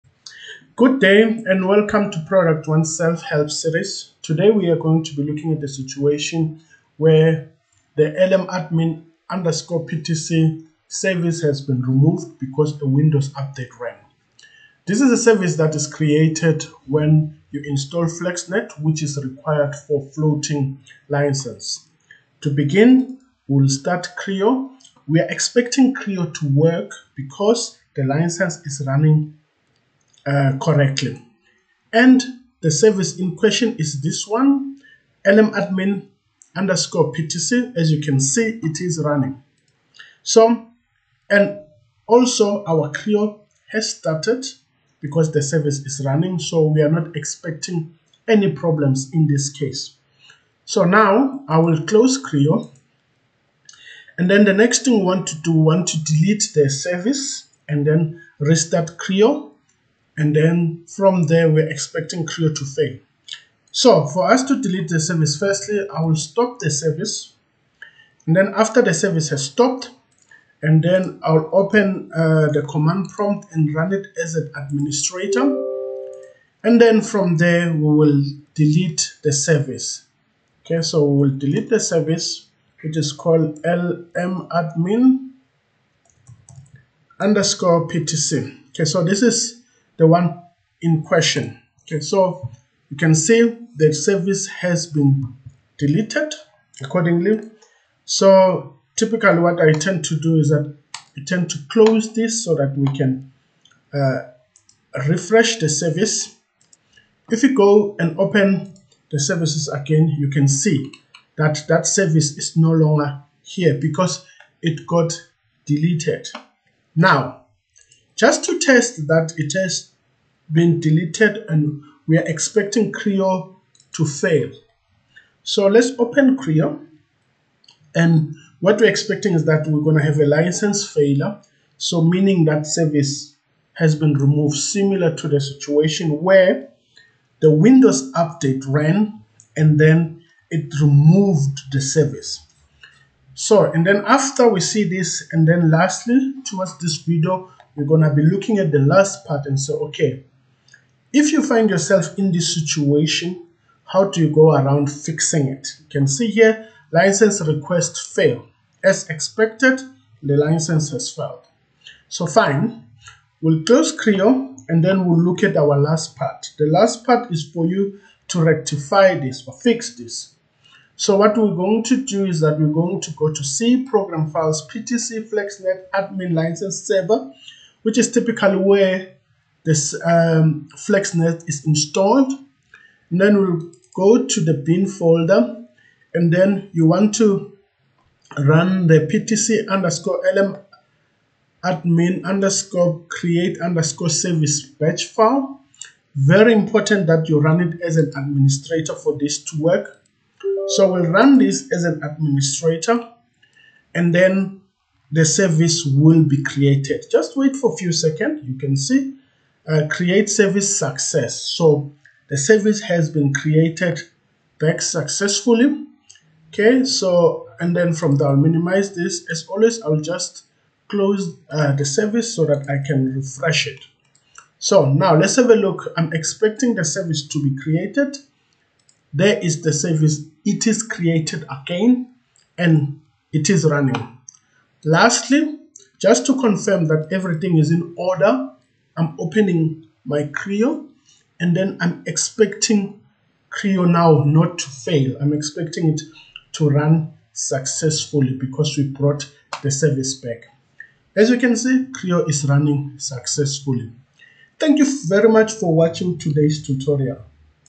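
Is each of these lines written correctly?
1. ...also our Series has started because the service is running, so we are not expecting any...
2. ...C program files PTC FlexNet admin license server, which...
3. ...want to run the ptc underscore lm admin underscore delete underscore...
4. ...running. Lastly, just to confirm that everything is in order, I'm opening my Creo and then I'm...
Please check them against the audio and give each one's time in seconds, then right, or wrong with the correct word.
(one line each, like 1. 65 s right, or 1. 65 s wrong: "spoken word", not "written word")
1. 42 s wrong: "Creo", not "Series"
2. 173 s right
3. 186 s wrong: "create", not "delete"
4. 233 s right.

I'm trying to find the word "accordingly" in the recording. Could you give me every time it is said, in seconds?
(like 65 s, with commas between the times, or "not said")
96 s.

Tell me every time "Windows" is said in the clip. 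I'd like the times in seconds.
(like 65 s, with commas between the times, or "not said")
12 s, 137 s.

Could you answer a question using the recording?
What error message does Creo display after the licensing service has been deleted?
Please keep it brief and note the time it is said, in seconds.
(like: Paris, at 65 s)
License request fail, at 156 s.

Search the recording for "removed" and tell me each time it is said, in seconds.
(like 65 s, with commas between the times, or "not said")
11 s, 134 s, 140 s.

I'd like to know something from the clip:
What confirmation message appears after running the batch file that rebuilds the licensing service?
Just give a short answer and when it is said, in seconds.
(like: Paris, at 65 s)
Create service success, at 209 s.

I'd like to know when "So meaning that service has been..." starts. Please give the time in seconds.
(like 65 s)
131 s.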